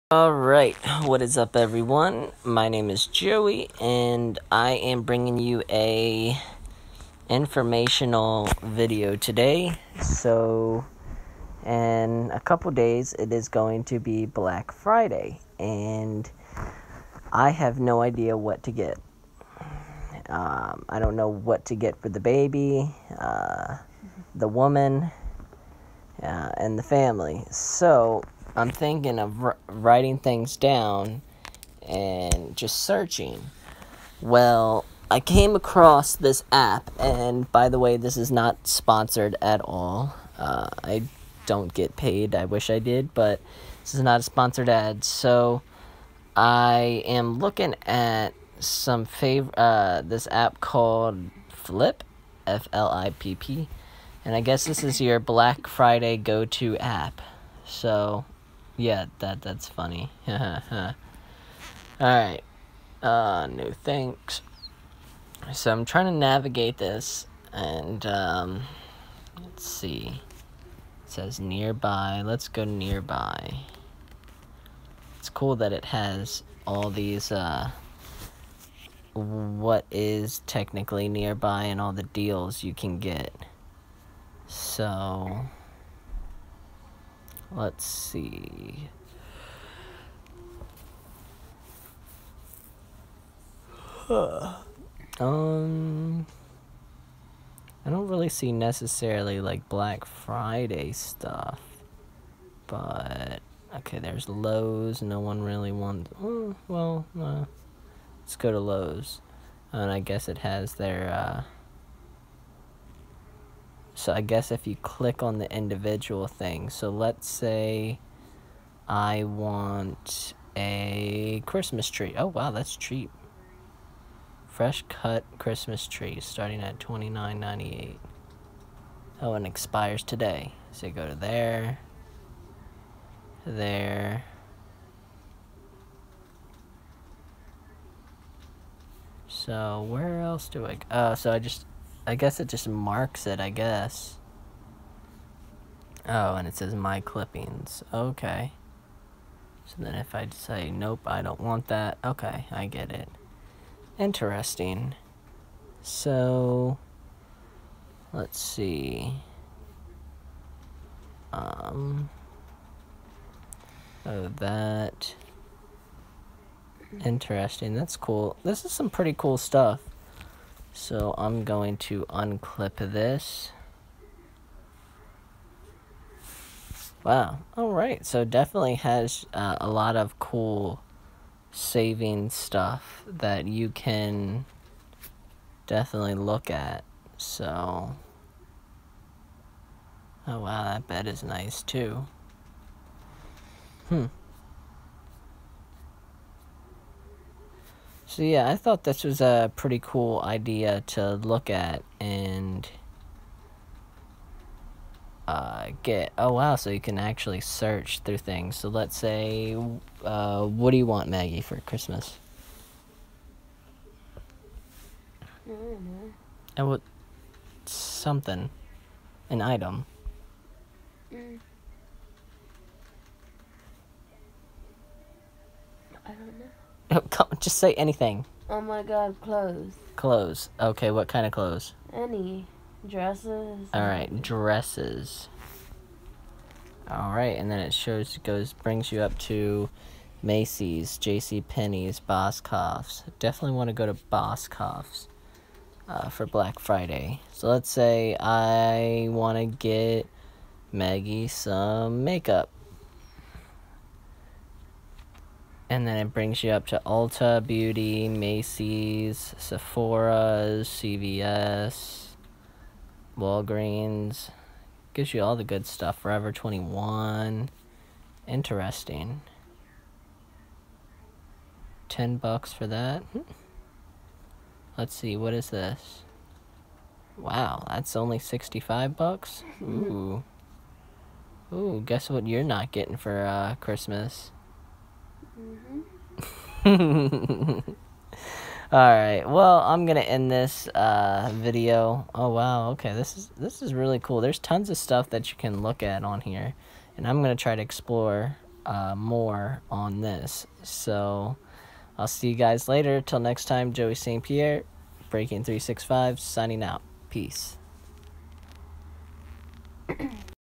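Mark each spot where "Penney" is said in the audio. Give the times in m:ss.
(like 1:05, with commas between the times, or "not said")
4:01.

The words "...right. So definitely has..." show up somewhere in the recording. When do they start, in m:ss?
2:57.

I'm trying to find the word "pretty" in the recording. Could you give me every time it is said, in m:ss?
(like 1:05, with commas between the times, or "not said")
2:48, 3:19.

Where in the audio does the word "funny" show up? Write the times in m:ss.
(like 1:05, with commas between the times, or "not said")
0:59.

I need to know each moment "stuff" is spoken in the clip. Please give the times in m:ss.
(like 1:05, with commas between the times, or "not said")
1:40, 2:49, 3:02, 4:25, 4:54.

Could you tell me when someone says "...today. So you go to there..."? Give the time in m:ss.
2:10.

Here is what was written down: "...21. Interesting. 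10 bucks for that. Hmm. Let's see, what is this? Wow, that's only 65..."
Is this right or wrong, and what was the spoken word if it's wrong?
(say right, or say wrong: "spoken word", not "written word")
right.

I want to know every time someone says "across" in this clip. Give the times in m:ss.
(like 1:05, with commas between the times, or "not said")
0:35.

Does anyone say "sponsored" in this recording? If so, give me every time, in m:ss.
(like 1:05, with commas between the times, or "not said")
0:38, 0:44.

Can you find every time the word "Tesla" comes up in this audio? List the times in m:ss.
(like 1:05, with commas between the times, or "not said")
not said.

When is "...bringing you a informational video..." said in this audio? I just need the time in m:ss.
0:05.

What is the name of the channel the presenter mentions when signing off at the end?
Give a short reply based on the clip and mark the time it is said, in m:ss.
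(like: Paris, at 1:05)
Breaking Three Six Five, at 5:05.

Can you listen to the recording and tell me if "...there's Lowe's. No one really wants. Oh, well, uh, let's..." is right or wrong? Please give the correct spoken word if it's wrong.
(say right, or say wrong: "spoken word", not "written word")
right.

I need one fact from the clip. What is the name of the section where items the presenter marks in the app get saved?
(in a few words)
My clippings.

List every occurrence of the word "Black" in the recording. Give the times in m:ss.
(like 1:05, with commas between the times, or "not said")
0:14, 0:55, 1:39, 4:06.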